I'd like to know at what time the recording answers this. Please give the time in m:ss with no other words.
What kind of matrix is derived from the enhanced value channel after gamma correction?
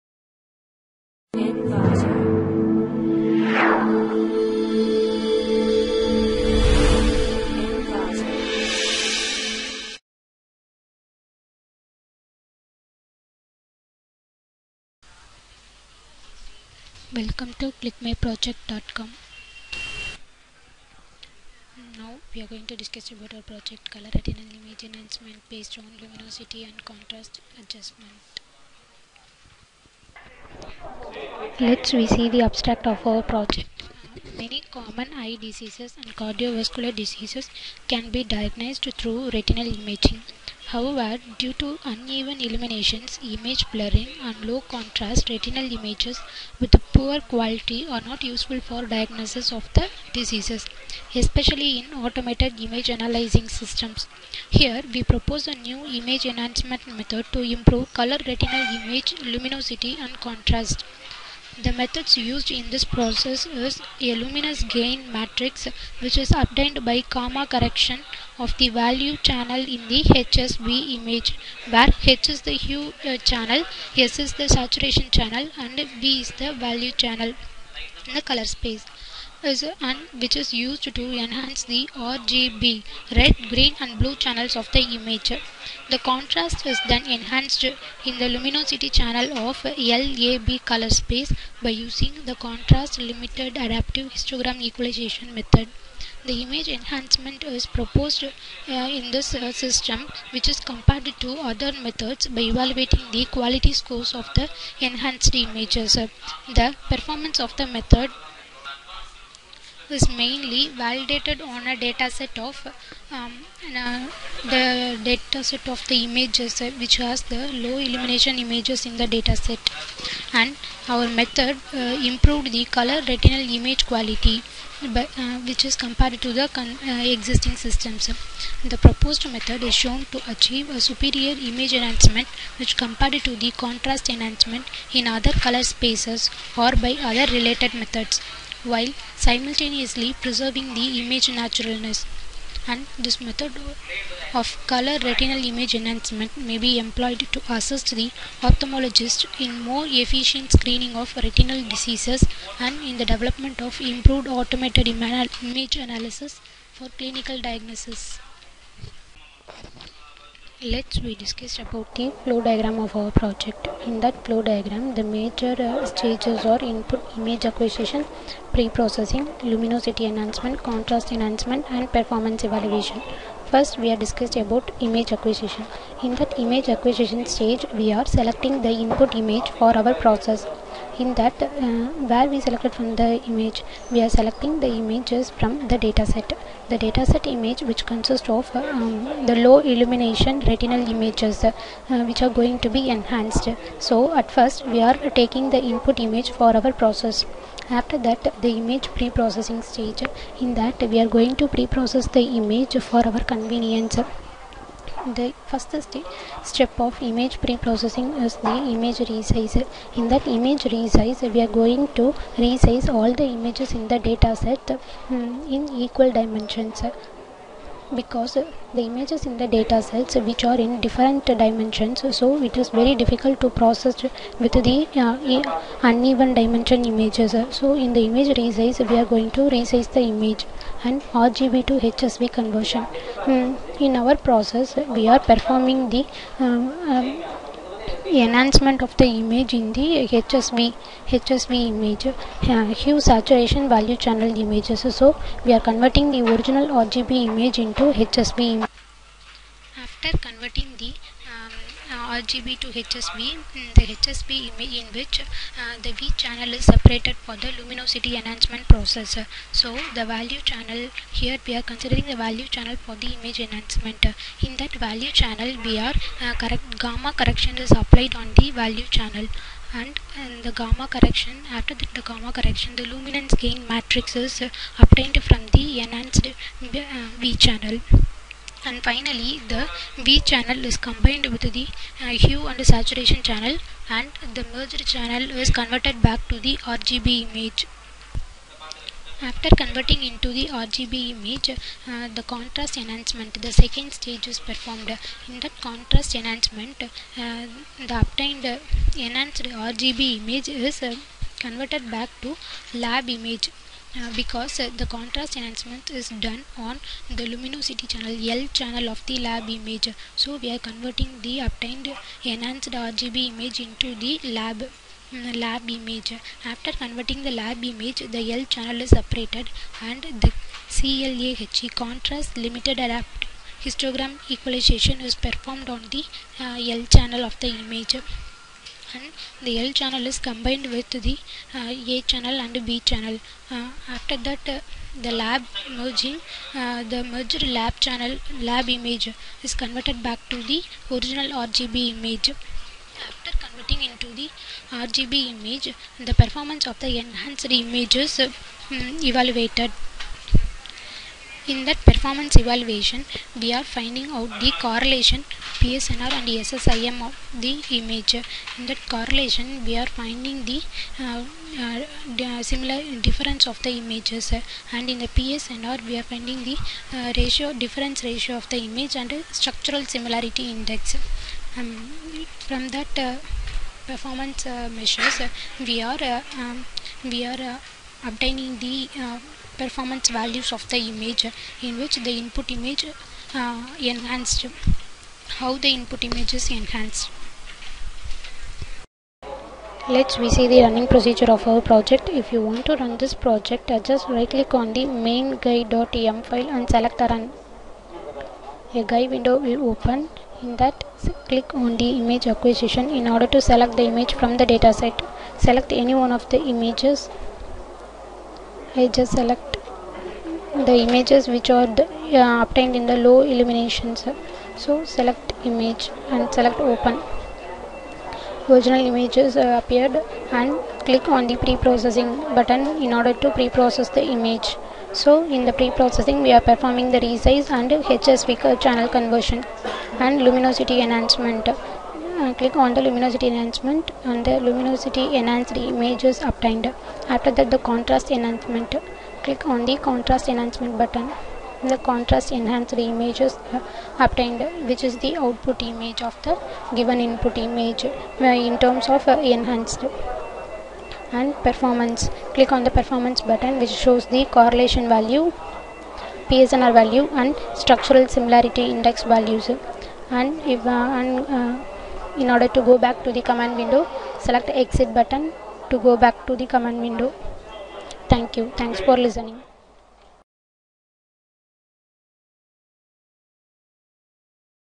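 4:32.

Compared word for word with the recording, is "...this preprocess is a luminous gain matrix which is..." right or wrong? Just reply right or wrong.
wrong.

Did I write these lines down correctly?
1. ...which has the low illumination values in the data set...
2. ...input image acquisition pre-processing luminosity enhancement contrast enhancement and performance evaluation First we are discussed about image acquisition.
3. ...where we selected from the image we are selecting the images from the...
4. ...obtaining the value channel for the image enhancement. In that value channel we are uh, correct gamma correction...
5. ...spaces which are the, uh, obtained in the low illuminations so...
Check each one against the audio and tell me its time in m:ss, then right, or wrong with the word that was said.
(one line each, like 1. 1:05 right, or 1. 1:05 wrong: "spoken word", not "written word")
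1. 1:56 wrong: "images", not "values"
2. 2:46 right
3. 3:02 right
4. 4:21 wrong: "considering", not "obtaining"
5. 6:50 wrong: "images", not "spaces".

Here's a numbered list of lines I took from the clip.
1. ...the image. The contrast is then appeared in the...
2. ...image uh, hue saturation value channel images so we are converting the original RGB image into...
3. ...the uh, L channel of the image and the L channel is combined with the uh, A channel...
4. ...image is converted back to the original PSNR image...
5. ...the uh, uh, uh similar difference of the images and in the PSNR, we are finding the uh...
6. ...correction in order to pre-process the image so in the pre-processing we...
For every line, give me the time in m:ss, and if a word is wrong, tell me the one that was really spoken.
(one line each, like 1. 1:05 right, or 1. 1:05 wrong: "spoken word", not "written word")
1. 1:24 wrong: "enhanced", not "appeared"
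2. 4:01 right
3. 5:25 right
4. 5:38 wrong: "RGB", not "PSNR"
5. 6:00 right
6. 7:02 wrong: "button", not "correction".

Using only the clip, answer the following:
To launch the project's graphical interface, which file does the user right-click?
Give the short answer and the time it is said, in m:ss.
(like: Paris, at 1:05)
main guide.em, at 6:35.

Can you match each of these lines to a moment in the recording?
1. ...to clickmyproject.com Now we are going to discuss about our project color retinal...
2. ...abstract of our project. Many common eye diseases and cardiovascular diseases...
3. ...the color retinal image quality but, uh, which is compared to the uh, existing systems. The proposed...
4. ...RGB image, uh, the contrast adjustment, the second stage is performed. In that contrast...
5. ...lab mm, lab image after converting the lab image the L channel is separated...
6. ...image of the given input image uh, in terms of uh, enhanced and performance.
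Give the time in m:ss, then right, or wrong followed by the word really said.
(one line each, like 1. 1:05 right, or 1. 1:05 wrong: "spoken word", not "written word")
1. 0:17 right
2. 0:32 right
3. 2:02 right
4. 4:50 wrong: "enhancement", not "adjustment"
5. 5:14 right
6. 7:25 right.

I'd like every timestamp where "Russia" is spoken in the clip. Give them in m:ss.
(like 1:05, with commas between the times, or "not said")
not said.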